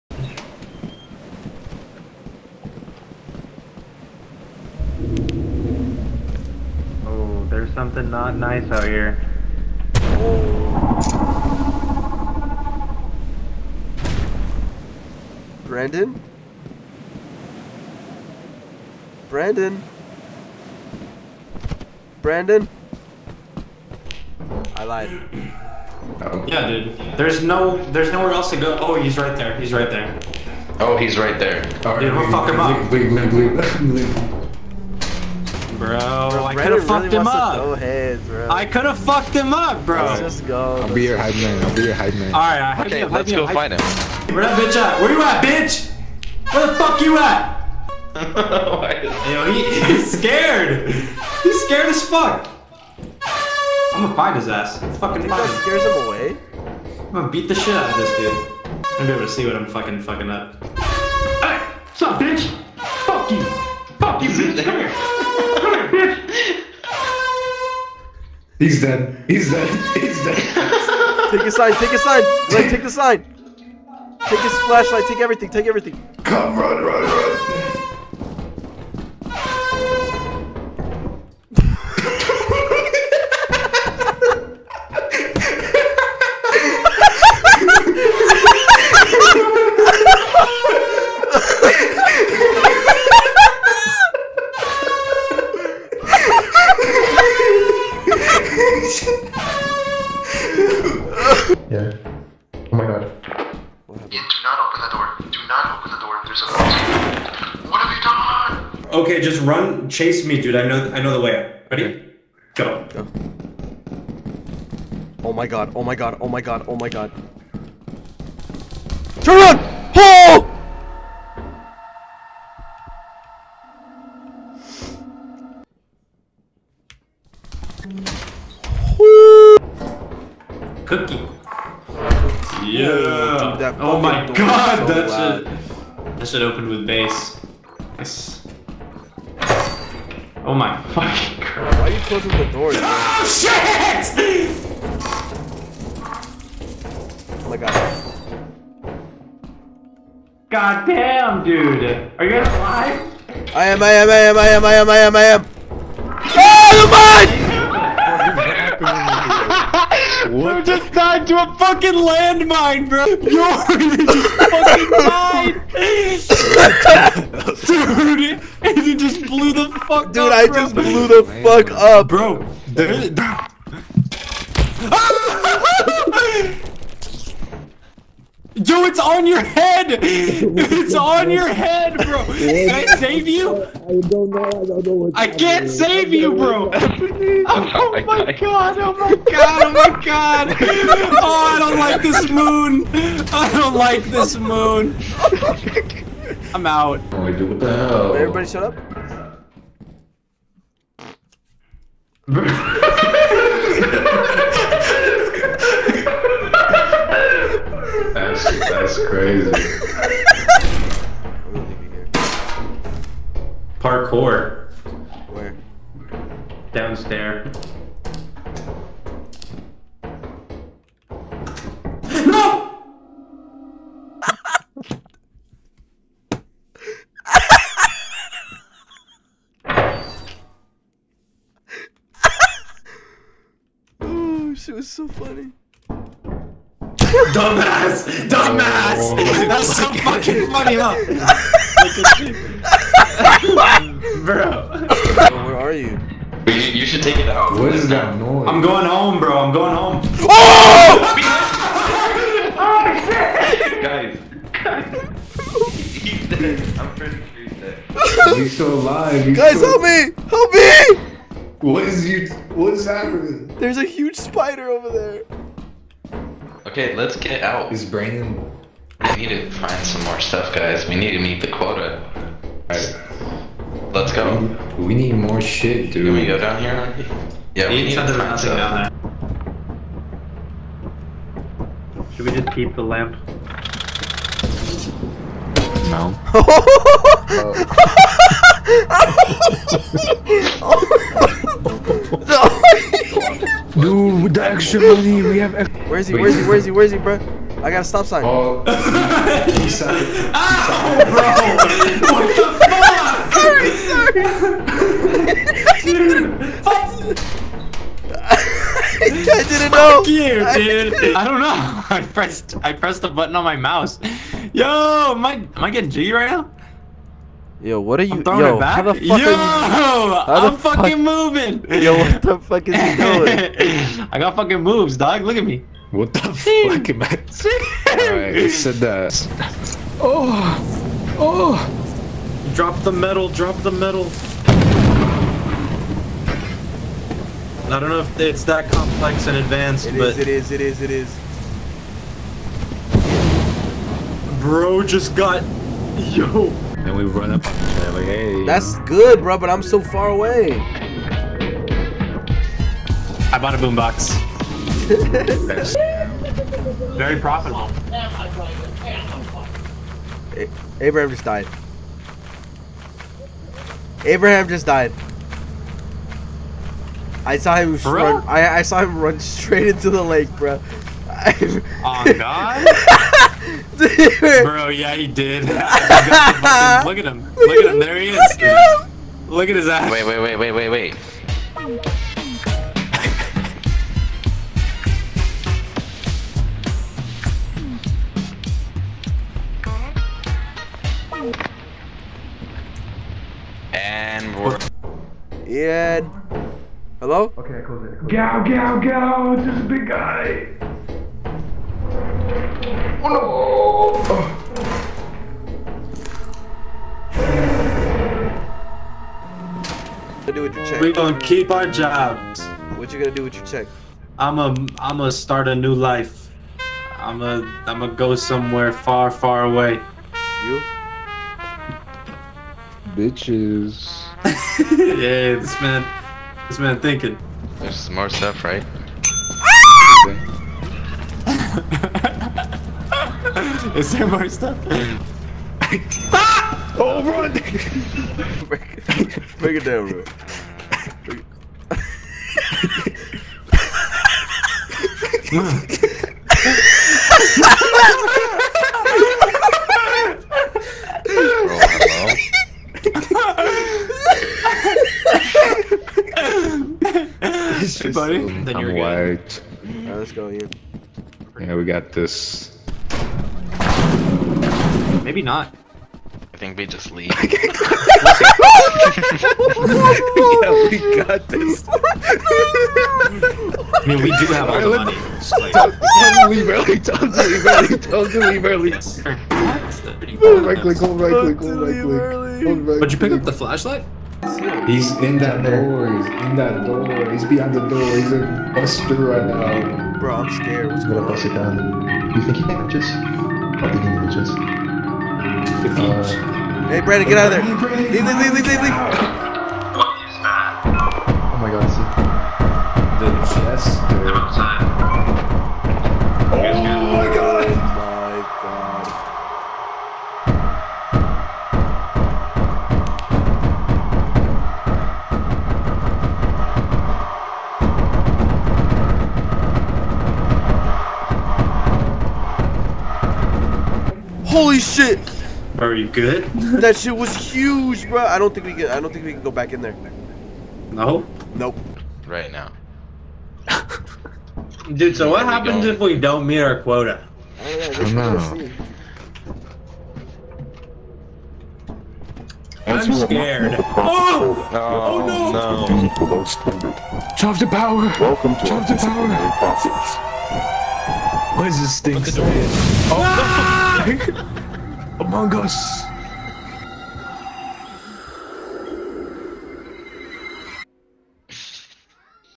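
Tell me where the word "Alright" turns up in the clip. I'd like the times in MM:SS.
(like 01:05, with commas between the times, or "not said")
04:32, 07:39.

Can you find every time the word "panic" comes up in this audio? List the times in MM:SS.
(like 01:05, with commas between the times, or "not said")
not said.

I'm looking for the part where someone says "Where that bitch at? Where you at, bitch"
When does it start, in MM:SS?
00:44.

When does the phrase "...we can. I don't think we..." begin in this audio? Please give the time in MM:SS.
08:48.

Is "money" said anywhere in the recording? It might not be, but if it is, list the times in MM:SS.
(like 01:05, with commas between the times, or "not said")
04:54, 07:54.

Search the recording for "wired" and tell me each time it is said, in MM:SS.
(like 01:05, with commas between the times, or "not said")
07:38.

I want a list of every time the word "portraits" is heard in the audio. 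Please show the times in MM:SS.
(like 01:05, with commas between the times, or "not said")
not said.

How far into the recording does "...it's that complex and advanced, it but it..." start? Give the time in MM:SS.
05:38.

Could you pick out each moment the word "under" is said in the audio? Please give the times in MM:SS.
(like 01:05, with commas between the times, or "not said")
not said.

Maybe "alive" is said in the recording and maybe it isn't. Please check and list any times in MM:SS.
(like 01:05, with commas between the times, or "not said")
02:32, 04:18.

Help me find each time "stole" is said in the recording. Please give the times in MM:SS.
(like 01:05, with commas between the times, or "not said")
not said.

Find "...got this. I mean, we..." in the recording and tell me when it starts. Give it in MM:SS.
07:51.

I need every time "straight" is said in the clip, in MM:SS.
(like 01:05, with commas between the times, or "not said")
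06:09.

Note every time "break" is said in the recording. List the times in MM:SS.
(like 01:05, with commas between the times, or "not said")
07:18.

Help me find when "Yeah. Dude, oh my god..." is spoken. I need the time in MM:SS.
02:12.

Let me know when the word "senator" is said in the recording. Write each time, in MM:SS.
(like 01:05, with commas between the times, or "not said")
not said.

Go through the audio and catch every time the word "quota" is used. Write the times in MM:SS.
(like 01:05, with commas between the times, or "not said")
04:31, 08:56.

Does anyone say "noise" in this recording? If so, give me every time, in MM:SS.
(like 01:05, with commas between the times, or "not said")
04:08.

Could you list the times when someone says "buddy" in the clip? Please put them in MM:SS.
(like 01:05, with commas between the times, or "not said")
07:37.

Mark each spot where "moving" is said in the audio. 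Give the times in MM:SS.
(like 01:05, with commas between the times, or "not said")
05:21.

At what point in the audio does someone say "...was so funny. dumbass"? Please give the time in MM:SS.
03:54.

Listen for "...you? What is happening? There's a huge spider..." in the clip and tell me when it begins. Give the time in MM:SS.
04:22.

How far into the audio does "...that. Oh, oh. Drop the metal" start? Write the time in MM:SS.
05:28.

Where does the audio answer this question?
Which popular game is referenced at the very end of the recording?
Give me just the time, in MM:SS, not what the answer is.
09:15.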